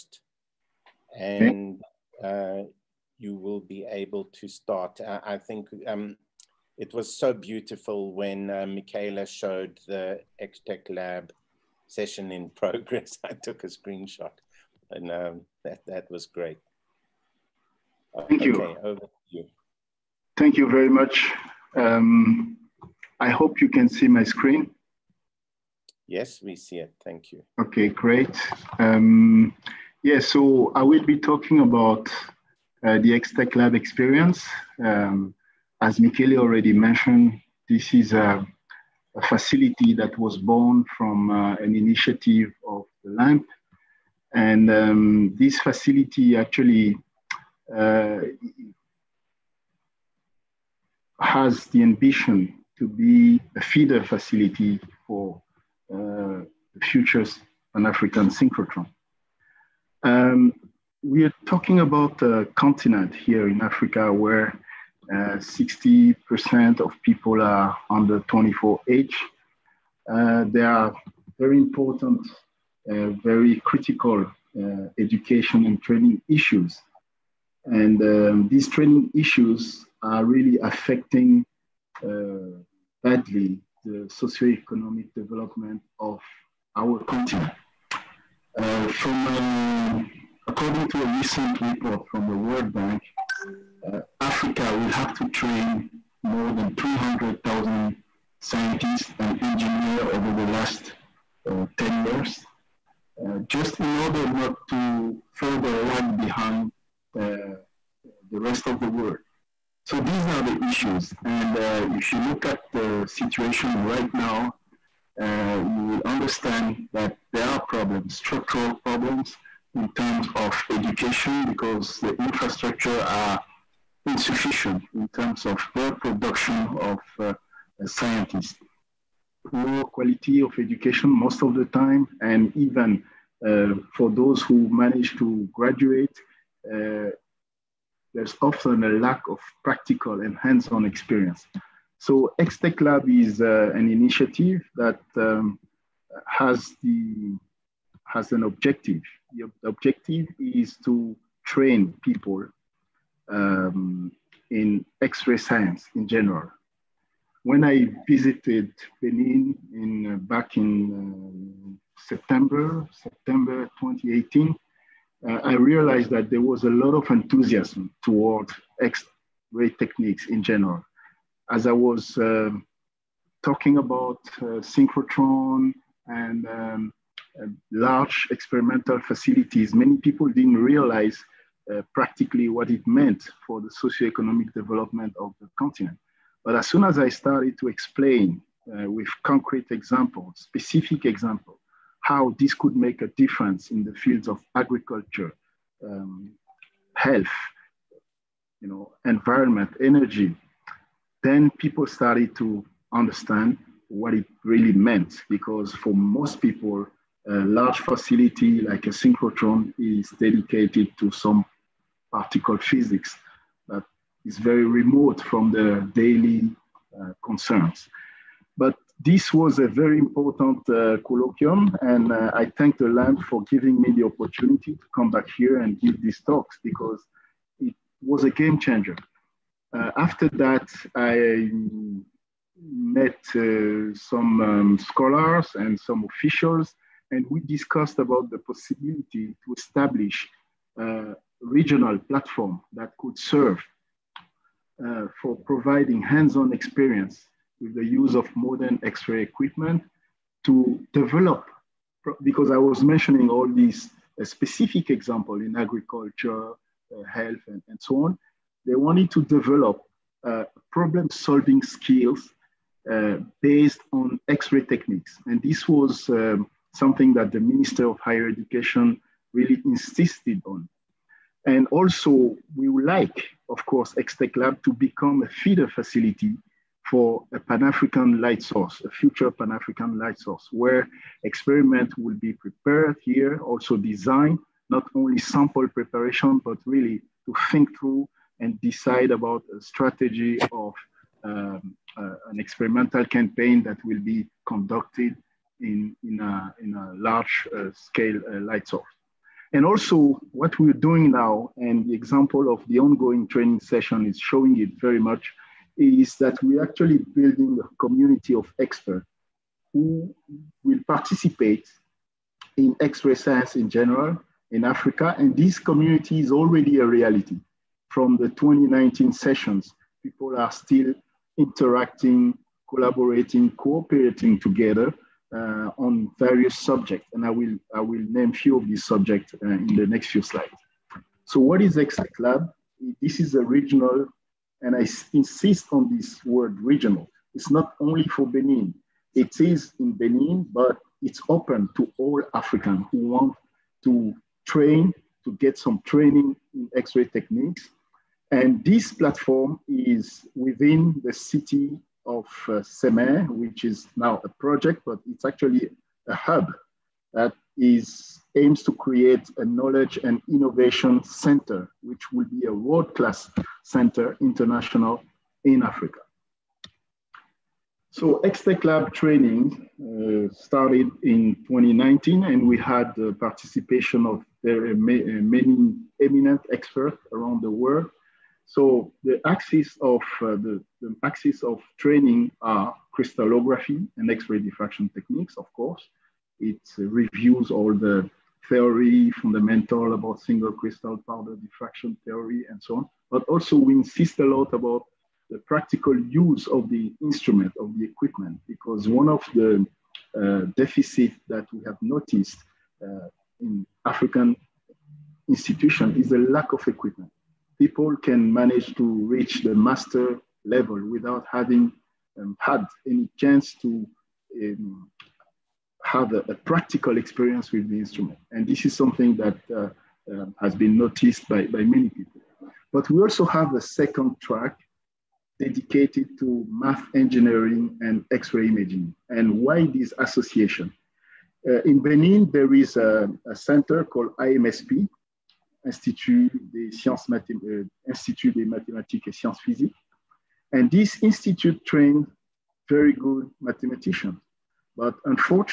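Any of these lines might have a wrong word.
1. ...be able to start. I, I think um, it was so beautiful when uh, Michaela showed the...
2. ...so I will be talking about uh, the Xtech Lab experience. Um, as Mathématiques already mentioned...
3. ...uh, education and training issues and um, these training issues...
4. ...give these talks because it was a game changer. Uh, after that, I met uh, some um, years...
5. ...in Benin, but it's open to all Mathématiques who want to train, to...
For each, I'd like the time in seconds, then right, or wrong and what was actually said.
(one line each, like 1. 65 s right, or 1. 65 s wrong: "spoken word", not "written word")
1. 3 s right
2. 30 s wrong: "Michele", not "Mathématiques"
3. 74 s right
4. 225 s wrong: "scholars", not "years"
5. 339 s wrong: "Africans", not "Mathématiques".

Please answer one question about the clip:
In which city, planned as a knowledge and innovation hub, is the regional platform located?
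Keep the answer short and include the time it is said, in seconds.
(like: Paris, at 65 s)
Sèmè, at 352 s.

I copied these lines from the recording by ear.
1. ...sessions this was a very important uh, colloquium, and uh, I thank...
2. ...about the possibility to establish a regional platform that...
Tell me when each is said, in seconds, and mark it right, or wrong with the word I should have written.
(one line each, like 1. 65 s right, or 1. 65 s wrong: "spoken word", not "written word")
1. 217 s wrong: "concerns", not "sessions"
2. 237 s right.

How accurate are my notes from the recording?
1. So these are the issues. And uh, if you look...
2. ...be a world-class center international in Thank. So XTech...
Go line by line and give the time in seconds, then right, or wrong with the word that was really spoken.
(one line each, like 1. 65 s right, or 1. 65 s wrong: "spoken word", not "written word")
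1. 109 s right
2. 362 s wrong: "Africa", not "Thank".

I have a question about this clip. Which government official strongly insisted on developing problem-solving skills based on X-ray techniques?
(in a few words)
Minister of Higher Education.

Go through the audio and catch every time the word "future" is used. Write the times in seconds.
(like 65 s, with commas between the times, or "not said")
56 s, 278 s.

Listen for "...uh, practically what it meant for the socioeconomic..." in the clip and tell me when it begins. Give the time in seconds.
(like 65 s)
181 s.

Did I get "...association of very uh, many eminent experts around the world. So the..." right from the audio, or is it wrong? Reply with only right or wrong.
wrong.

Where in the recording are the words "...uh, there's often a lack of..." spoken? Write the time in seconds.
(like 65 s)
136 s.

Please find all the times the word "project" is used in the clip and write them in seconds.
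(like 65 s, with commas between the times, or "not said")
354 s.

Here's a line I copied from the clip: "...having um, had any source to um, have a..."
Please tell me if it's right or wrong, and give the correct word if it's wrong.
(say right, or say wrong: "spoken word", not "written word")
wrong: "chance", not "source".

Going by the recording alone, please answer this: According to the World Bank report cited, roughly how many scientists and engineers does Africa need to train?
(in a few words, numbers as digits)
300,000.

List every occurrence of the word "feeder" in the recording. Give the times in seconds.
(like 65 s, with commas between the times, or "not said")
53 s, 275 s.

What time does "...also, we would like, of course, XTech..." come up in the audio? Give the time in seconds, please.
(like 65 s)
271 s.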